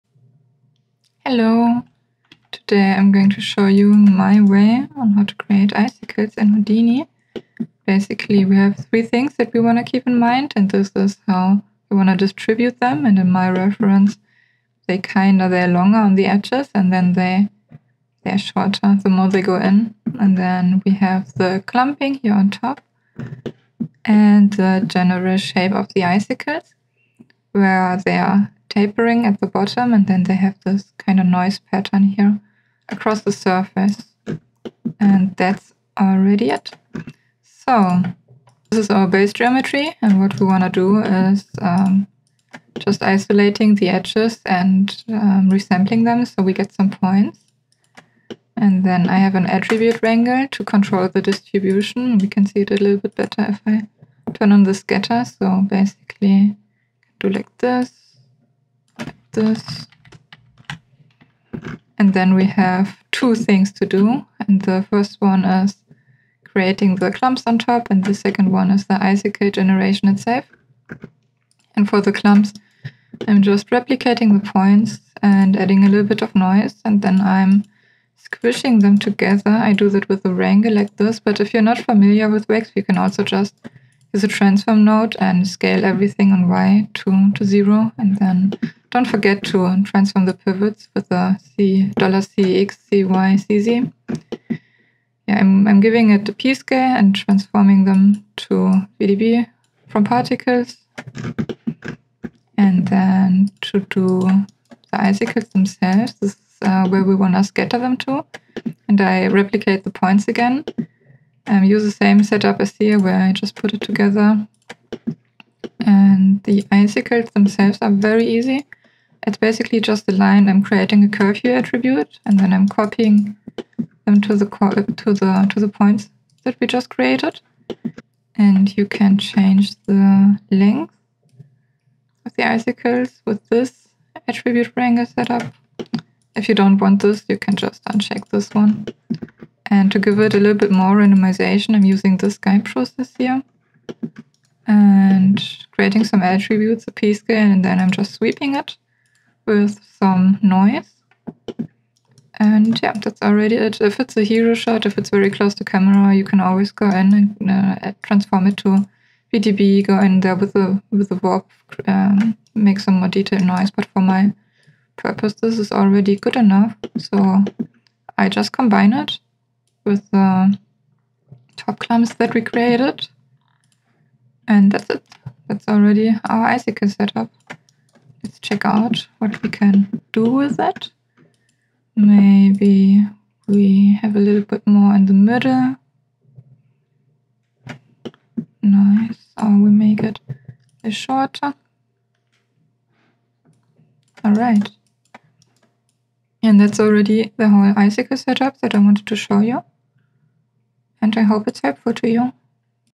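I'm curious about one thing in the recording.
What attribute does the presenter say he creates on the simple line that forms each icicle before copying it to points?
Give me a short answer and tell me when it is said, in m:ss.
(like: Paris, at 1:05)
curveu, at 2:01.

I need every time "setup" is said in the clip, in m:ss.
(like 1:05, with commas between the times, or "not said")
1:52, 2:15, 2:56, 3:18.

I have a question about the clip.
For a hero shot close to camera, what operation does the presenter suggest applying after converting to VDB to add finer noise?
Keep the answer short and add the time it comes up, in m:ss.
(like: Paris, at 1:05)
warp, at 2:41.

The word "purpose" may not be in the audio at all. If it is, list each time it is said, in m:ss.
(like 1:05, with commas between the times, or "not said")
2:44.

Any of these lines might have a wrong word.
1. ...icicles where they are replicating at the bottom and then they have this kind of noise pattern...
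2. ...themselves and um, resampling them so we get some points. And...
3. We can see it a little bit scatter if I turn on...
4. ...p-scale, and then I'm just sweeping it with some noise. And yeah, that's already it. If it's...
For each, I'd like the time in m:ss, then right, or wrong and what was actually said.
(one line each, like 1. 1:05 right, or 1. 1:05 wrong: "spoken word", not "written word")
1. 0:26 wrong: "tapering", not "replicating"
2. 0:43 wrong: "edges", not "themselves"
3. 0:52 wrong: "better", not "scatter"
4. 2:26 right.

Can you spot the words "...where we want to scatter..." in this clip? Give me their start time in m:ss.
1:46.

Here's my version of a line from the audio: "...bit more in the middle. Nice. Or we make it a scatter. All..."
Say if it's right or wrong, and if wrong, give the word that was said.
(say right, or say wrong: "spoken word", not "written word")
wrong: "shorter", not "scatter".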